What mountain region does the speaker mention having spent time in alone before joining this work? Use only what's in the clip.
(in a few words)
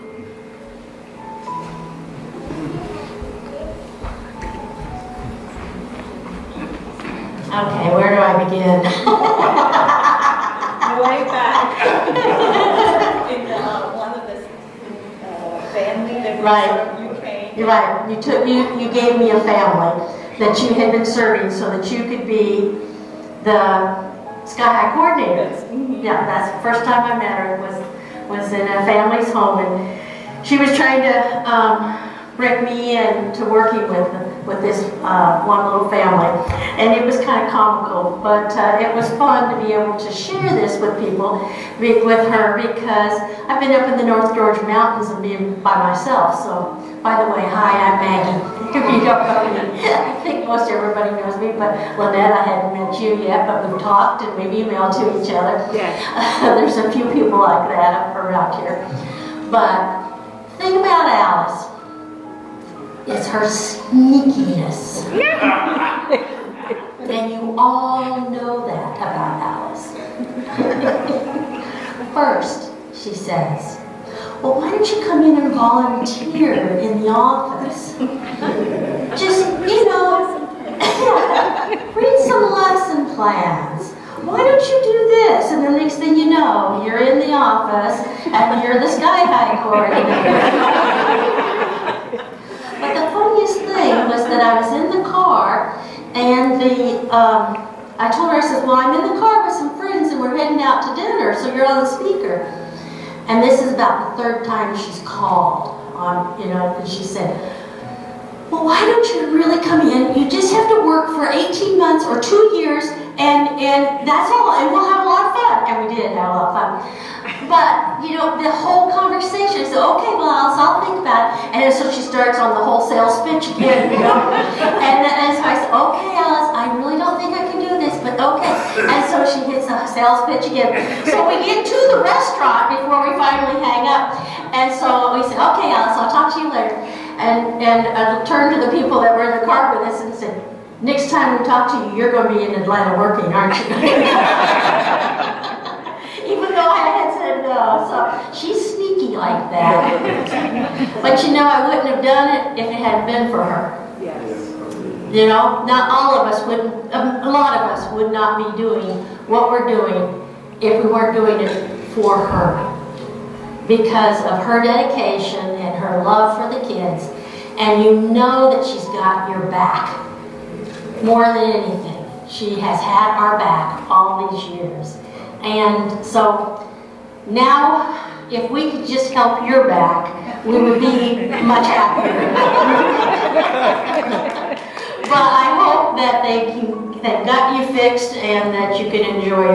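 North Georgia Mountains.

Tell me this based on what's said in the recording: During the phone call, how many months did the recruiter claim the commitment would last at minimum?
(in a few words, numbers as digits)
18.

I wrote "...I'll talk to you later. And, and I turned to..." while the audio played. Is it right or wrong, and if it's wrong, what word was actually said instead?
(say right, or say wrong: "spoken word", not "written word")
right.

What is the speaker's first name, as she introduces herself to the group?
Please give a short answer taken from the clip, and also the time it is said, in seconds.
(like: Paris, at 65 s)
Maggie, at 47 s.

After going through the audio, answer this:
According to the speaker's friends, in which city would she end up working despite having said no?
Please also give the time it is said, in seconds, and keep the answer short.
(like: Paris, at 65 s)
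Atlanta, at 142 s.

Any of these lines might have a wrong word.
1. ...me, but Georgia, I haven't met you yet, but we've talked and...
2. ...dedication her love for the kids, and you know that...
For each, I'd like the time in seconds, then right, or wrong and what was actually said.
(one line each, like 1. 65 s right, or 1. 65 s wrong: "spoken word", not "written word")
1. 51 s wrong: "Lynette", not "Georgia"
2. 164 s right.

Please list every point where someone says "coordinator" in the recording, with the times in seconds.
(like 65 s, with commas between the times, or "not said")
24 s, 89 s.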